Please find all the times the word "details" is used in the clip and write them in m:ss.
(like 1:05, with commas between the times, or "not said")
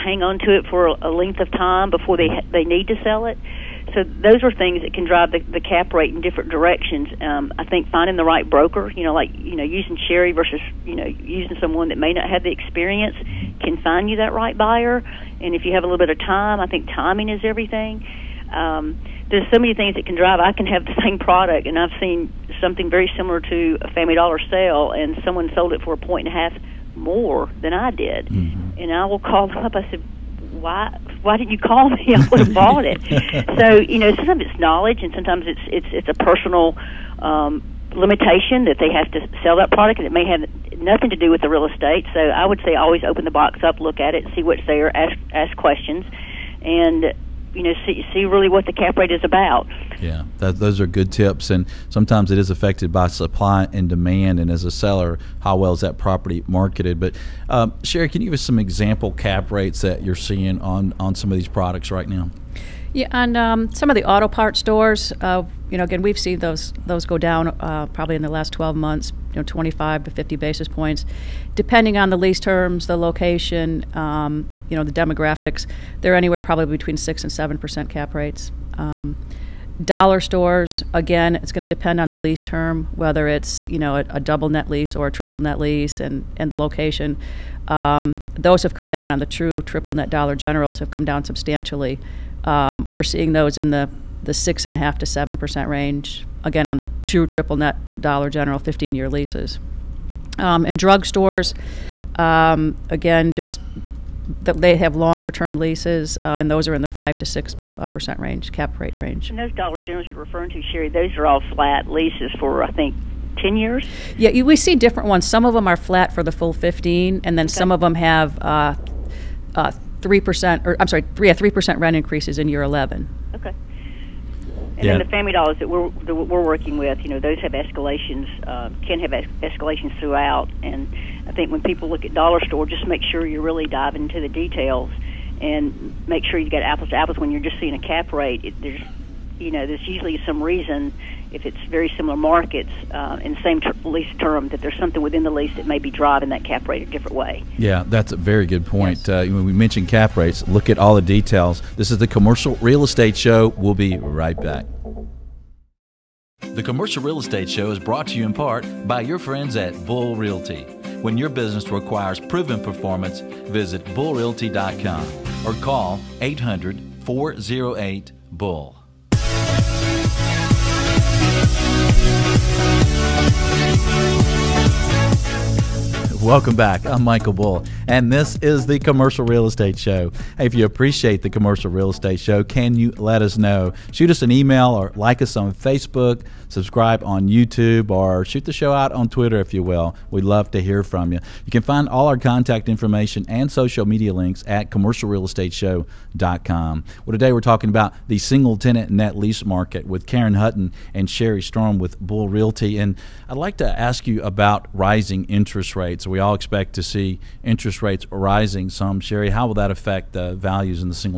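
2:14, 2:31.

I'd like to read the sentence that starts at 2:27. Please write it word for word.
Yeah, that's a very good point.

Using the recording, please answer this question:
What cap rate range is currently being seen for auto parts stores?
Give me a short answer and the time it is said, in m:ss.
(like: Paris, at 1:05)
6 to 7 percent, at 1:16.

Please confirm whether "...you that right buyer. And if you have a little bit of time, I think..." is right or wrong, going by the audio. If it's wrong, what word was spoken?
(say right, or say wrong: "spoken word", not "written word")
right.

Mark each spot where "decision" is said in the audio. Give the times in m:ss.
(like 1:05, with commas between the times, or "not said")
not said.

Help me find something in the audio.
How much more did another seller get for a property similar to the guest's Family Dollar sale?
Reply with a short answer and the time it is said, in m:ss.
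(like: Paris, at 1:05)
a point and a half, at 0:25.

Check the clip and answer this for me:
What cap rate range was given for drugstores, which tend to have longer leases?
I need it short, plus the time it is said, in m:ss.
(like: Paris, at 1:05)
5 to 6 percent, at 1:46.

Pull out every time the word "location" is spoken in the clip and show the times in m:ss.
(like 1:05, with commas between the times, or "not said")
1:12, 1:26.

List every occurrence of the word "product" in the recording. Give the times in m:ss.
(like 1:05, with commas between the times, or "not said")
0:21, 0:39, 1:01.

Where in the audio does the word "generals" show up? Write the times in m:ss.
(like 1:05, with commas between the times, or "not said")
1:30, 1:38, 1:49.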